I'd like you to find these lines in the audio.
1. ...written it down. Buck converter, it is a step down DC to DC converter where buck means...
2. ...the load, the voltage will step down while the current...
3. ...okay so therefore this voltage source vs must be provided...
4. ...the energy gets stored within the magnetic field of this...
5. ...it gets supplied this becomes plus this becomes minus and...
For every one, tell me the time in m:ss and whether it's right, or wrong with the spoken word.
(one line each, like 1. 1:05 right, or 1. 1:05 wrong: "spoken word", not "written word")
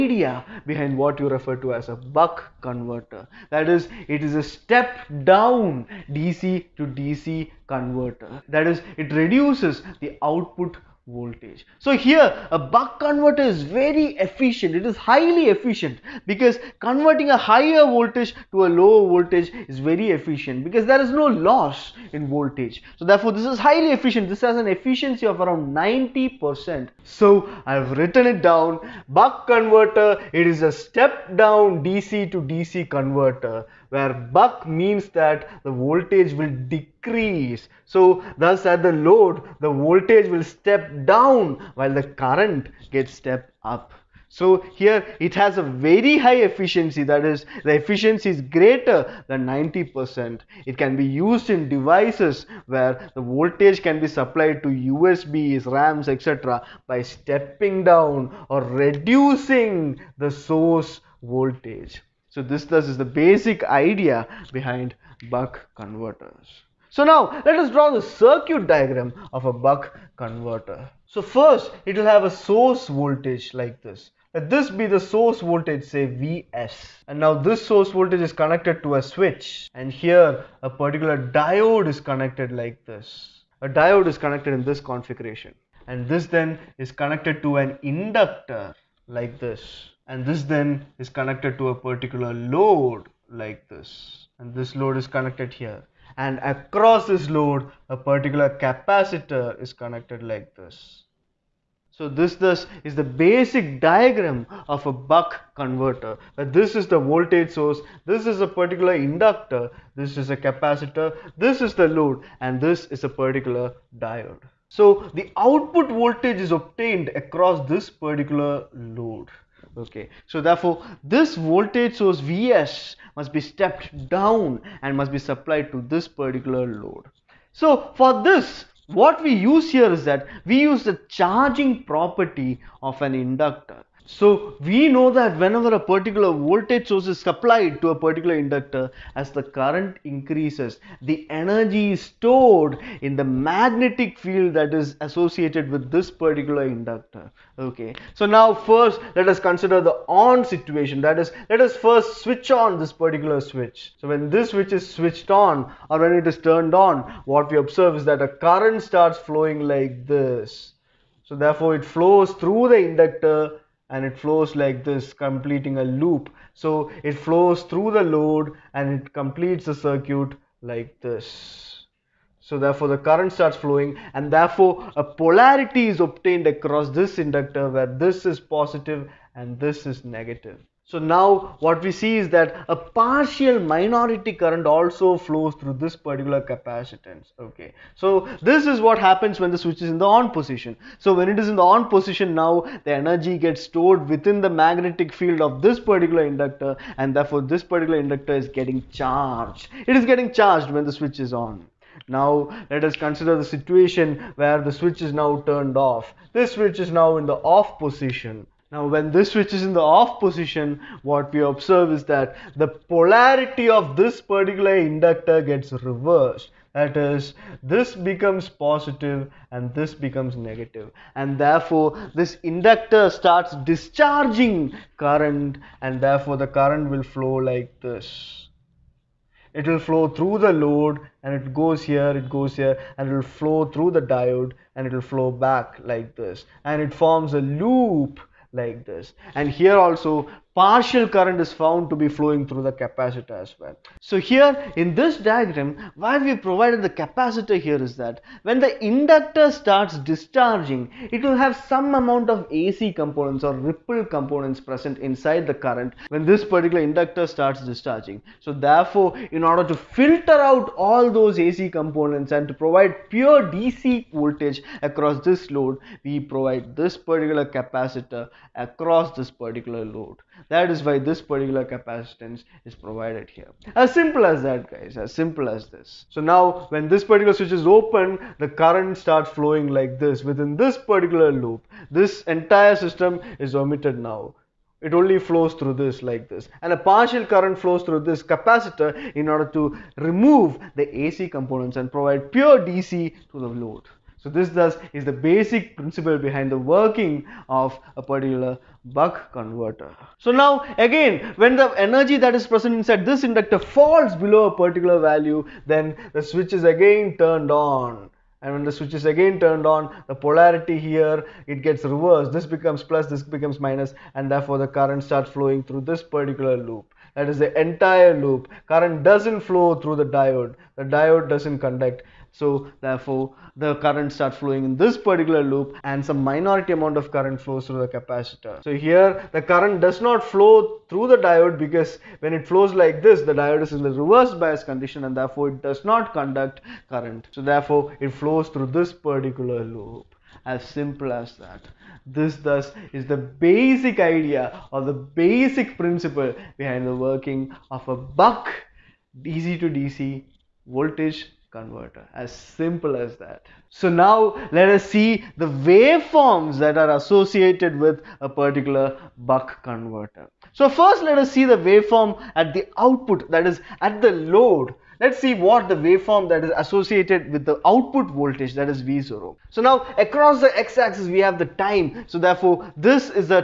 1. 0:27 right
2. 0:38 right
3. 1:59 wrong: "stepped", not "provided"
4. 3:12 right
5. 5:11 wrong: "reversed", not "supplied".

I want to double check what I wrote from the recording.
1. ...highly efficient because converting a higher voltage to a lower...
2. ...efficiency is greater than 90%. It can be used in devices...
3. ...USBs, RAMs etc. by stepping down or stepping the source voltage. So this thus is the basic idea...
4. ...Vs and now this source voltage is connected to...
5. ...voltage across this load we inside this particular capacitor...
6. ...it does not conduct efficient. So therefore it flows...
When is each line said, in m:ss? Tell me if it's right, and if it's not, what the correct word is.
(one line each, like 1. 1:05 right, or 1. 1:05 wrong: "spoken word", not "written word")
1. 0:14 right
2. 0:47 right
3. 0:54 wrong: "reducing", not "stepping"
4. 1:16 right
5. 4:24 wrong: "provide", not "inside"
6. 5:35 wrong: "current", not "efficient".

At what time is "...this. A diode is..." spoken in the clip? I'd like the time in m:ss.
1:22.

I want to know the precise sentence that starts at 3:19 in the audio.
It is getting charged when the switch is on.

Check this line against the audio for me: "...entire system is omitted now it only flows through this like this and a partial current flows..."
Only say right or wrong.
right.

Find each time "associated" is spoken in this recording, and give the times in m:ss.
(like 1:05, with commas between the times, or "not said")
2:25, 5:56, 6:06.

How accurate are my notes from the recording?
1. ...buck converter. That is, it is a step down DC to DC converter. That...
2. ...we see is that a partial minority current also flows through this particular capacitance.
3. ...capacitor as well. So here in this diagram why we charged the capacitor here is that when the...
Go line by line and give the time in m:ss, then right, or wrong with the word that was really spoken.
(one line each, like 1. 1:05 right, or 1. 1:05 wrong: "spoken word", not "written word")
1. 0:01 right
2. 3:01 right
3. 4:02 wrong: "provided", not "charged".